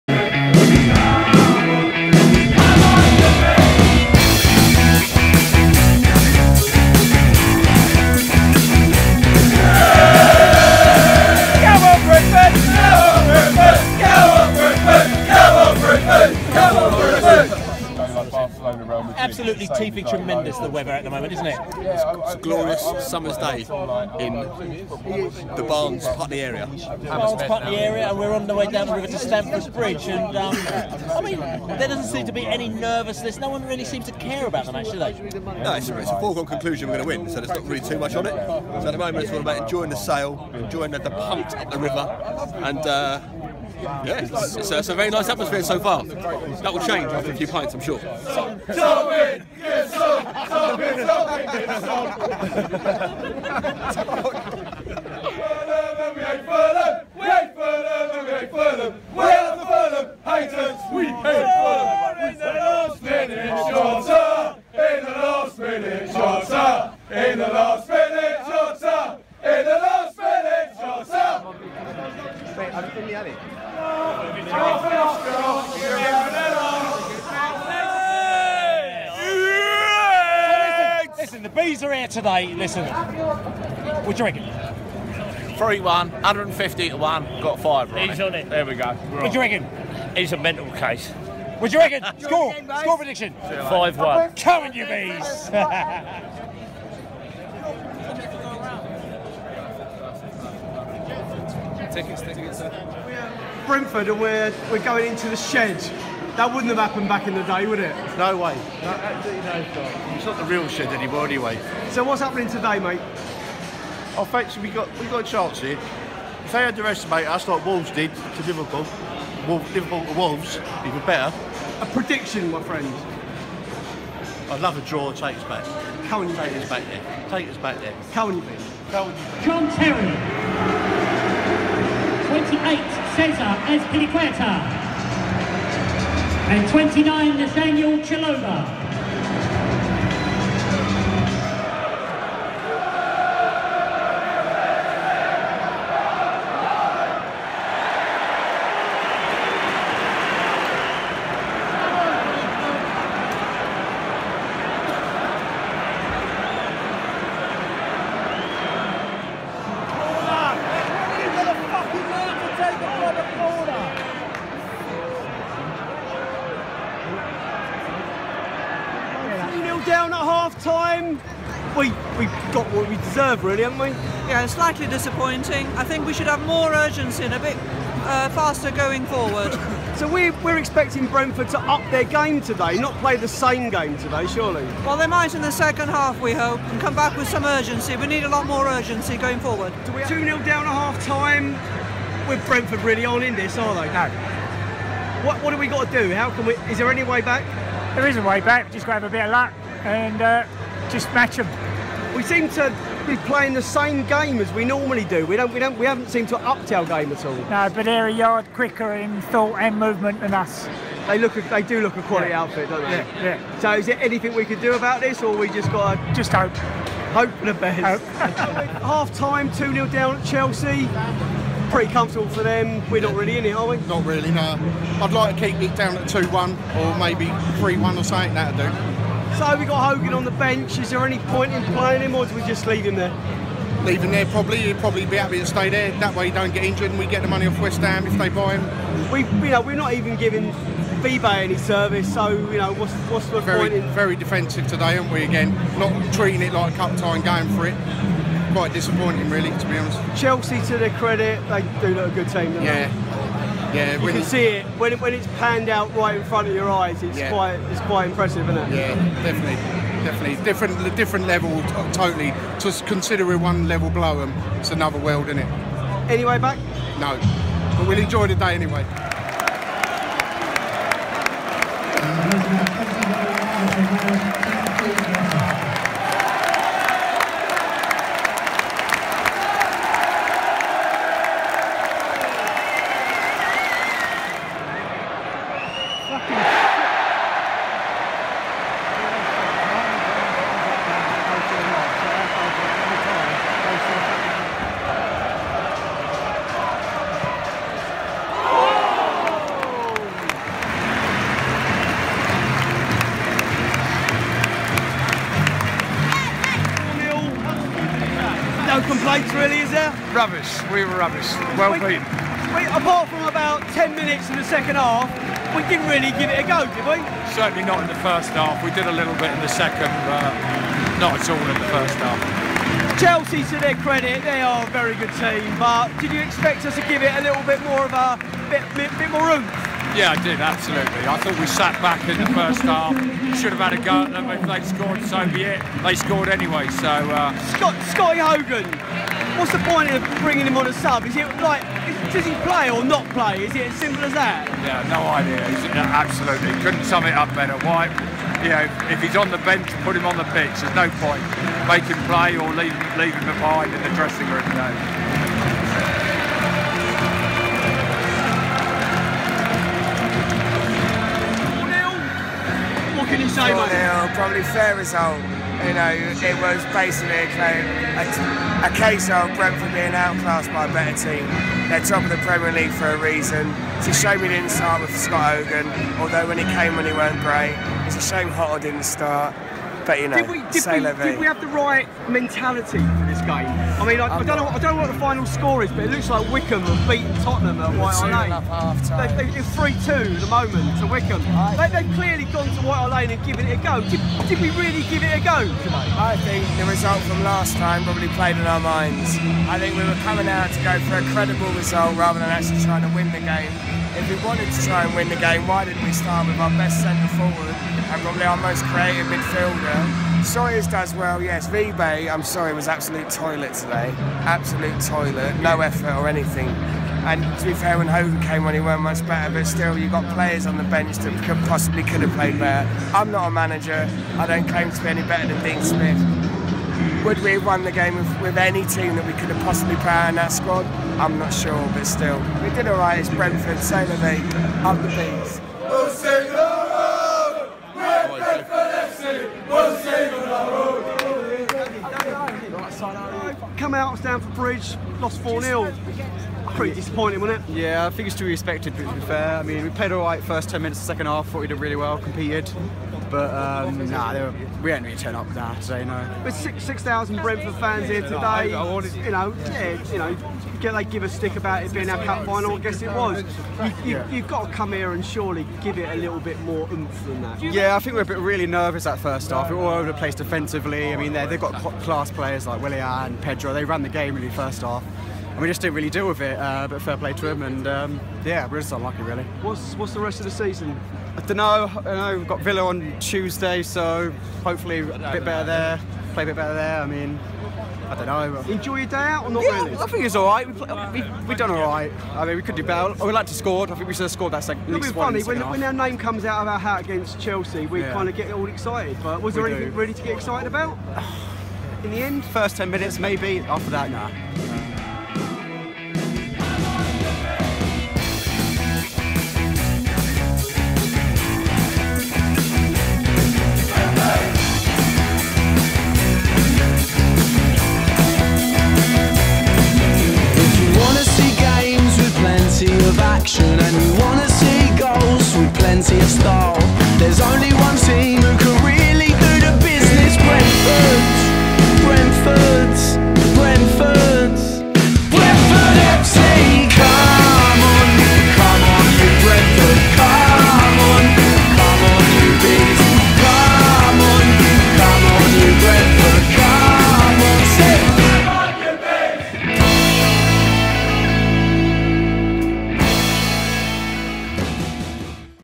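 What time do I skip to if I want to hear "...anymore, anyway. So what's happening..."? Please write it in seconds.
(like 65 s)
110 s.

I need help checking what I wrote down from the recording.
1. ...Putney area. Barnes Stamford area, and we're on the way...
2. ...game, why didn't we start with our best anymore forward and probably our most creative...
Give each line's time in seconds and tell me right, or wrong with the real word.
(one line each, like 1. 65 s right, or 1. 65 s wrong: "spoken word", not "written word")
1. 26 s wrong: "Putney", not "Stamford"
2. 405 s wrong: "centre", not "anymore".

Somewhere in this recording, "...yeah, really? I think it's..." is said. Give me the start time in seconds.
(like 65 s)
489 s.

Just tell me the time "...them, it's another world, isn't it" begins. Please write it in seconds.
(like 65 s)
264 s.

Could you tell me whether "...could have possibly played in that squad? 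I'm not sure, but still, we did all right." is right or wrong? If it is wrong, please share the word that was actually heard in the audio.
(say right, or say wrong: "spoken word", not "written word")
right.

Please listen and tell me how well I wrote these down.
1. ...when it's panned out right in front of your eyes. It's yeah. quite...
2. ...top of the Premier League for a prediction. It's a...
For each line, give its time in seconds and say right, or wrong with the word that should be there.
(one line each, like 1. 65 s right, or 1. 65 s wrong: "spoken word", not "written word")
1. 254 s right
2. 371 s wrong: "reason", not "prediction".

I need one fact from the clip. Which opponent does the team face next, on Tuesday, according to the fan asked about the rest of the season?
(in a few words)
Villa.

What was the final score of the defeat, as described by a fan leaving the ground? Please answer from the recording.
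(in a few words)
4-0.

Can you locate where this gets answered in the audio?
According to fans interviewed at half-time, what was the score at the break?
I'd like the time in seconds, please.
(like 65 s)
189 s.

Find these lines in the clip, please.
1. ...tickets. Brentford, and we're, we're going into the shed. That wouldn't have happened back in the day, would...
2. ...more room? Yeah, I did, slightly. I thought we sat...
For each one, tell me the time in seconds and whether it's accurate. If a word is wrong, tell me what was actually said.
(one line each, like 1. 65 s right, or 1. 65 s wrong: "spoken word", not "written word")
1. 102 s right
2. 329 s wrong: "absolutely", not "slightly".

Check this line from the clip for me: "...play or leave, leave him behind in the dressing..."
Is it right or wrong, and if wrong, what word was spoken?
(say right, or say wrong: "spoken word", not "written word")
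right.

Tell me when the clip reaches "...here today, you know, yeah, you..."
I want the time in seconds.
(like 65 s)
457 s.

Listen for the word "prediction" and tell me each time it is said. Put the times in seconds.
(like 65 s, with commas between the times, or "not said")
92 s, 121 s.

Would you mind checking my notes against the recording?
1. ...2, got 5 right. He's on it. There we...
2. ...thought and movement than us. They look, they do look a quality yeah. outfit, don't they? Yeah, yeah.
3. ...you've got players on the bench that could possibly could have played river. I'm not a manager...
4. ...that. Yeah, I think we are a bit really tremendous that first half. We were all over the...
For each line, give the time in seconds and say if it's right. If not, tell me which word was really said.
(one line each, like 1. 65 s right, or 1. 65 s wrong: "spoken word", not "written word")
1. 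86 s wrong: "1", not "2"
2. 209 s right
3. 419 s wrong: "better", not "river"
4. 467 s wrong: "nervous", not "tremendous".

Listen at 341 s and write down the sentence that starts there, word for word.
Is it like, is, does he play or not play?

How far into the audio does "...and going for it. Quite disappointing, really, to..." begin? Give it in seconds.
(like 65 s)
247 s.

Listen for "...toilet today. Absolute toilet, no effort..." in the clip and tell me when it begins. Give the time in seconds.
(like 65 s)
413 s.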